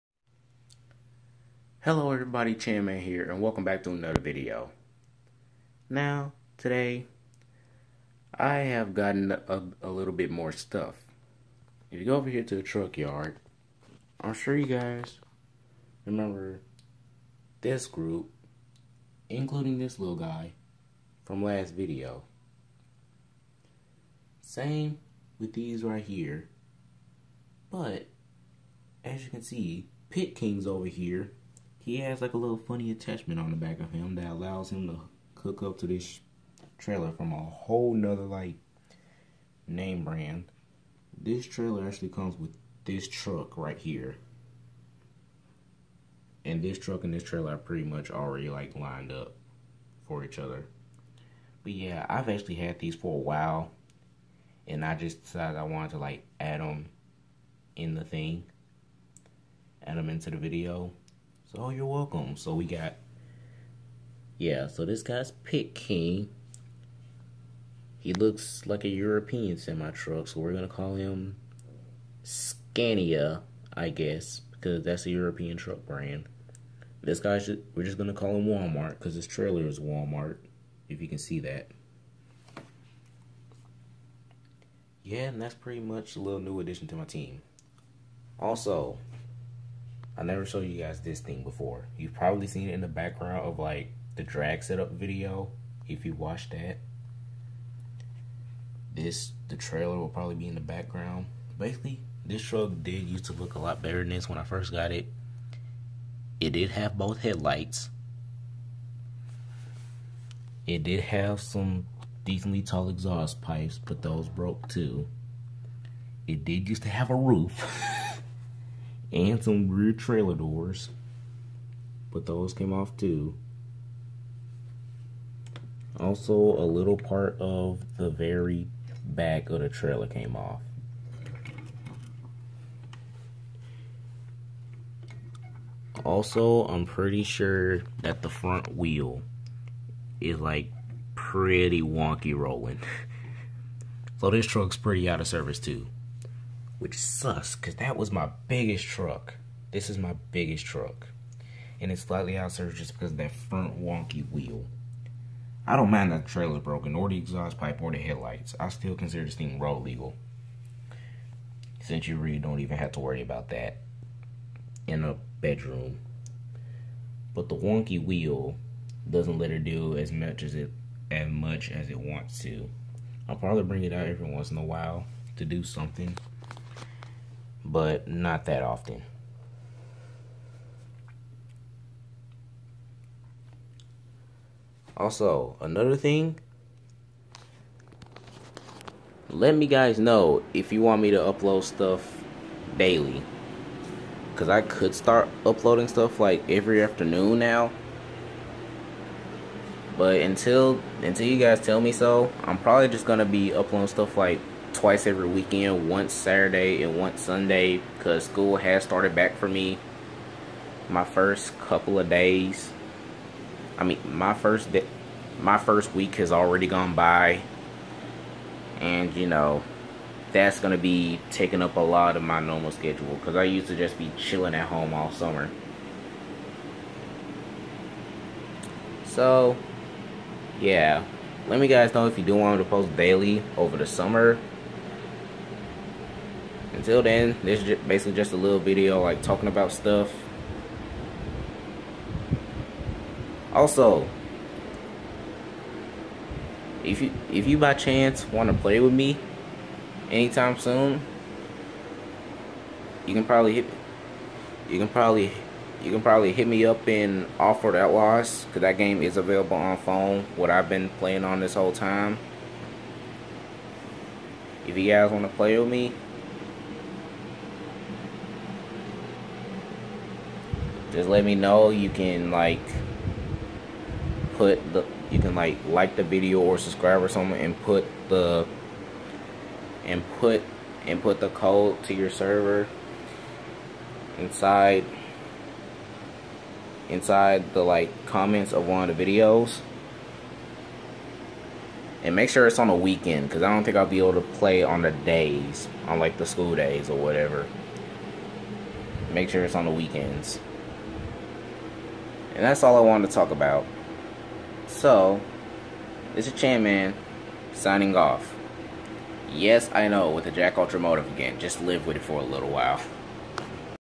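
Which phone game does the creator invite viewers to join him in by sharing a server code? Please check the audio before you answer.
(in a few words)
Offroad Outlaws.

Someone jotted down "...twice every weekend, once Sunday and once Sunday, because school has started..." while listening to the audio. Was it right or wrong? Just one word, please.
wrong.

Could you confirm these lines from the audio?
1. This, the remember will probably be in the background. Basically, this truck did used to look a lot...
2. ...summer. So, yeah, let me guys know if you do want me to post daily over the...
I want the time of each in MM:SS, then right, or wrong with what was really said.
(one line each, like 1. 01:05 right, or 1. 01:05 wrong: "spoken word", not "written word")
1. 01:38 wrong: "trailer", not "remember"
2. 03:45 right.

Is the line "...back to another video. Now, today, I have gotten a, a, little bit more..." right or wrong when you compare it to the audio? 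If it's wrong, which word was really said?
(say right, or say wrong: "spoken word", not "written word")
right.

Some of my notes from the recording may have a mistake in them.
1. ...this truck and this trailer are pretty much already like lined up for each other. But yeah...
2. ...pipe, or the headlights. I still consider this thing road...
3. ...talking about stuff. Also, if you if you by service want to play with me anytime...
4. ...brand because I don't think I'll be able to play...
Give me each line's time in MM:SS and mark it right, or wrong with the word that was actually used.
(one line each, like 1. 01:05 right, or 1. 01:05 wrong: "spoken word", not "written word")
1. 00:46 right
2. 02:37 right
3. 03:59 wrong: "chance", not "service"
4. 04:52 wrong: "weekend", not "brand".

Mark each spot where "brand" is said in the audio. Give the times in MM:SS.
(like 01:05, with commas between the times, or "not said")
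00:40, 01:15.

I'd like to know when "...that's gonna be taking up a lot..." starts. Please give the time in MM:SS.
03:40.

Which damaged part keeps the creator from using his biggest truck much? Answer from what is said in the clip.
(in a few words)
front wheel.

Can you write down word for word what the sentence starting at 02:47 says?
But the wonky wheel doesn't let her do as much as it as much as it wants to.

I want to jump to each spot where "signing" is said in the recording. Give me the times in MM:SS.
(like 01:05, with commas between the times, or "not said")
05:07.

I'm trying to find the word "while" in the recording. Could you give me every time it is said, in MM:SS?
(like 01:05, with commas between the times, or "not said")
00:53, 02:54, 05:12.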